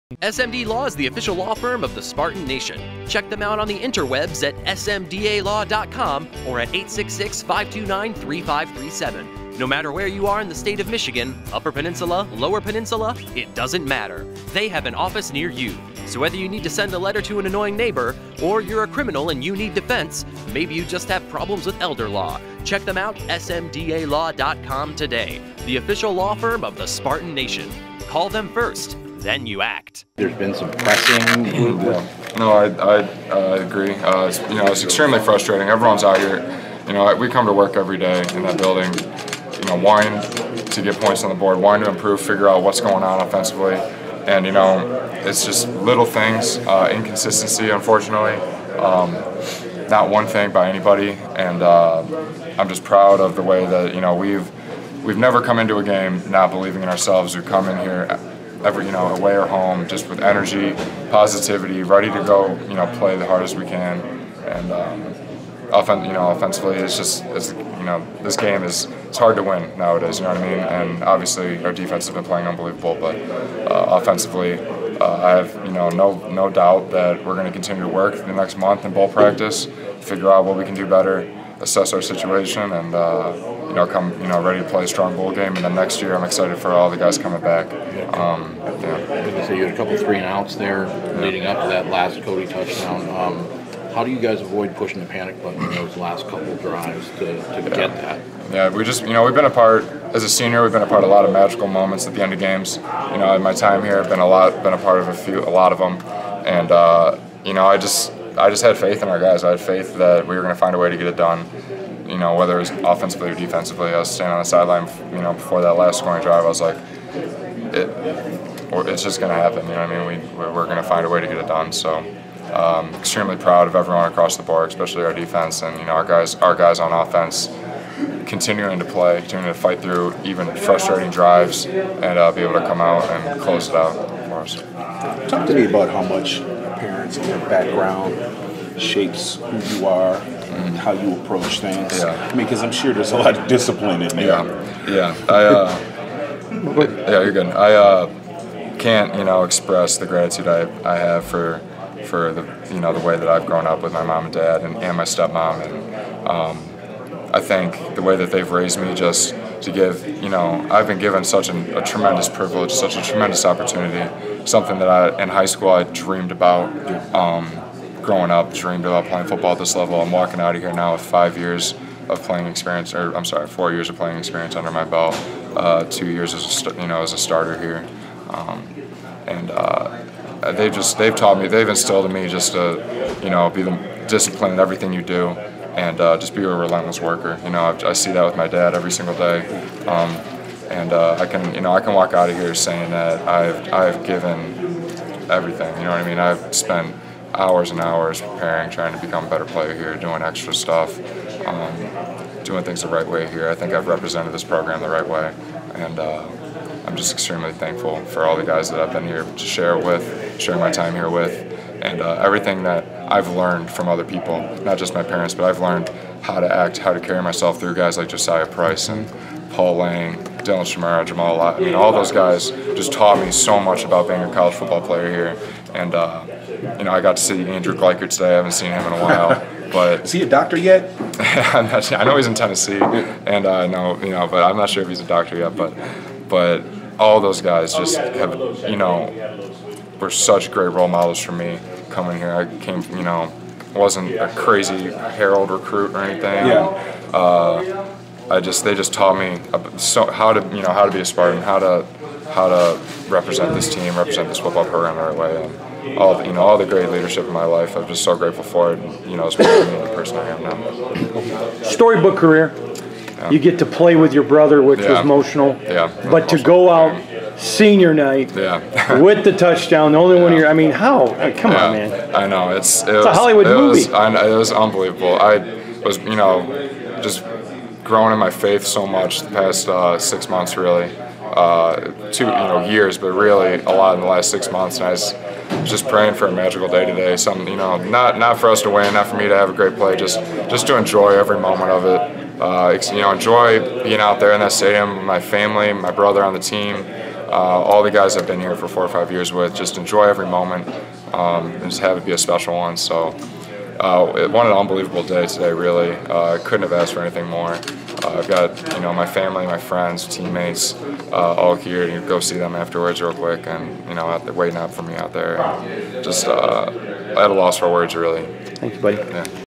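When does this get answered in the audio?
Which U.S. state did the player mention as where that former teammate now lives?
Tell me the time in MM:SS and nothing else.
03:52.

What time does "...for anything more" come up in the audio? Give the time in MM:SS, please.
05:06.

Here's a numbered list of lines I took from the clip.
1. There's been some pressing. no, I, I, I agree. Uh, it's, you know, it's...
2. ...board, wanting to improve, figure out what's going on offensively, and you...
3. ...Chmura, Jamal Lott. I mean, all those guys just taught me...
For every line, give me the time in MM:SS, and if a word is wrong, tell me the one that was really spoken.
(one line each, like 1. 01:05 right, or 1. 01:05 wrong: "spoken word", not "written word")
1. 00:30 right
2. 00:41 right
3. 03:40 right.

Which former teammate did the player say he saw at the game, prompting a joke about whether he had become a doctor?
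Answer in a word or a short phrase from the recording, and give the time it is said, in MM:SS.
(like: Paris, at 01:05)
Andrew Gleichert, at 03:47.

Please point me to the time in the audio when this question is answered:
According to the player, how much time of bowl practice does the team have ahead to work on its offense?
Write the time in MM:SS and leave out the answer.
01:18.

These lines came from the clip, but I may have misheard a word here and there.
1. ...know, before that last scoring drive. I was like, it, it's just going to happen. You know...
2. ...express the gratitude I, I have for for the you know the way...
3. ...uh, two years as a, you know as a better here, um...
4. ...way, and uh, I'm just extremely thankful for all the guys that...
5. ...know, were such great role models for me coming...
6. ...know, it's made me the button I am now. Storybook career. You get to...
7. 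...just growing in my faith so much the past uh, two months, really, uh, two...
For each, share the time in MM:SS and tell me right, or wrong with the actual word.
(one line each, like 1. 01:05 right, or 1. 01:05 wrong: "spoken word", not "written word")
1. 01:55 right
2. 02:29 right
3. 02:55 wrong: "starter", not "better"
4. 03:25 right
5. 03:58 right
6. 04:19 wrong: "person", not "button"
7. 04:37 wrong: "six", not "two".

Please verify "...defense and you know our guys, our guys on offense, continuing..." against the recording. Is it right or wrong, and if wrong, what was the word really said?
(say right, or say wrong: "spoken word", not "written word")
right.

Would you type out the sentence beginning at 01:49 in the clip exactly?
I had faith that we were going to find a way to get it done.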